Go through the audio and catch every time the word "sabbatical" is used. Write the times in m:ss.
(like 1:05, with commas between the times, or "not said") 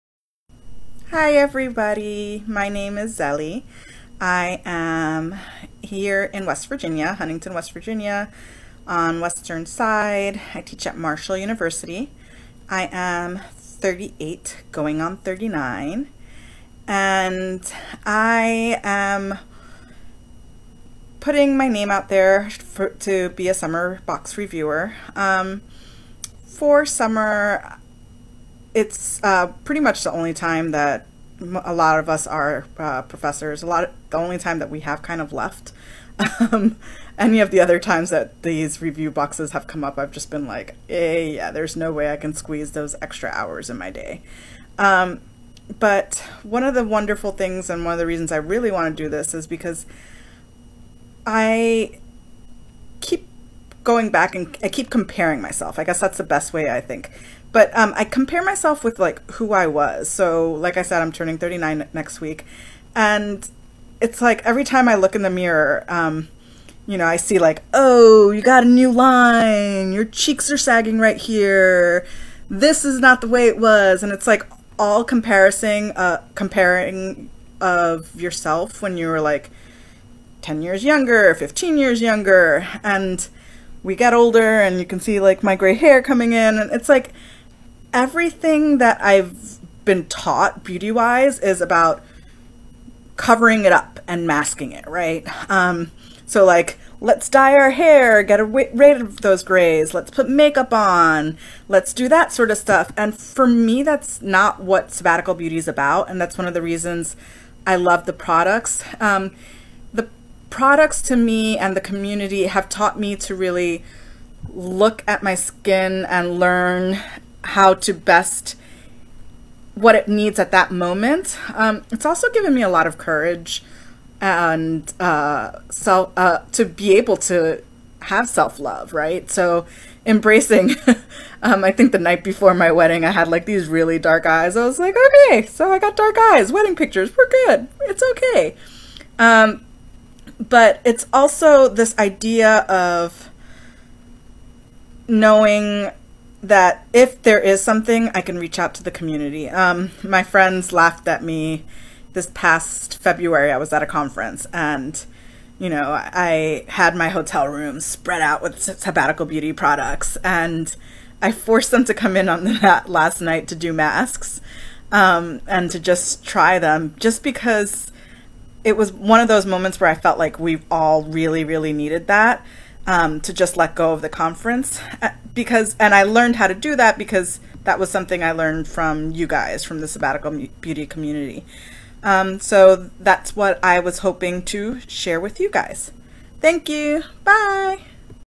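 1:44, 2:38, 2:59.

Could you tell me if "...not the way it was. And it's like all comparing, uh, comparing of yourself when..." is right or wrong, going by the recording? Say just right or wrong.
right.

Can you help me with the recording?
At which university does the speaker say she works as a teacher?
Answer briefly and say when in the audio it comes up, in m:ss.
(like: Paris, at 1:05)
Marshall University, at 0:10.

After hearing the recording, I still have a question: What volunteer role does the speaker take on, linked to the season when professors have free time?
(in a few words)
summer box reviewer.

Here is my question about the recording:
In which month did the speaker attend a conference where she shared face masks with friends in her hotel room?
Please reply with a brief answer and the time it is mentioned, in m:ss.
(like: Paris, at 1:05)
February, at 2:32.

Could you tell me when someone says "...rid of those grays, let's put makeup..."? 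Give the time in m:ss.
1:38.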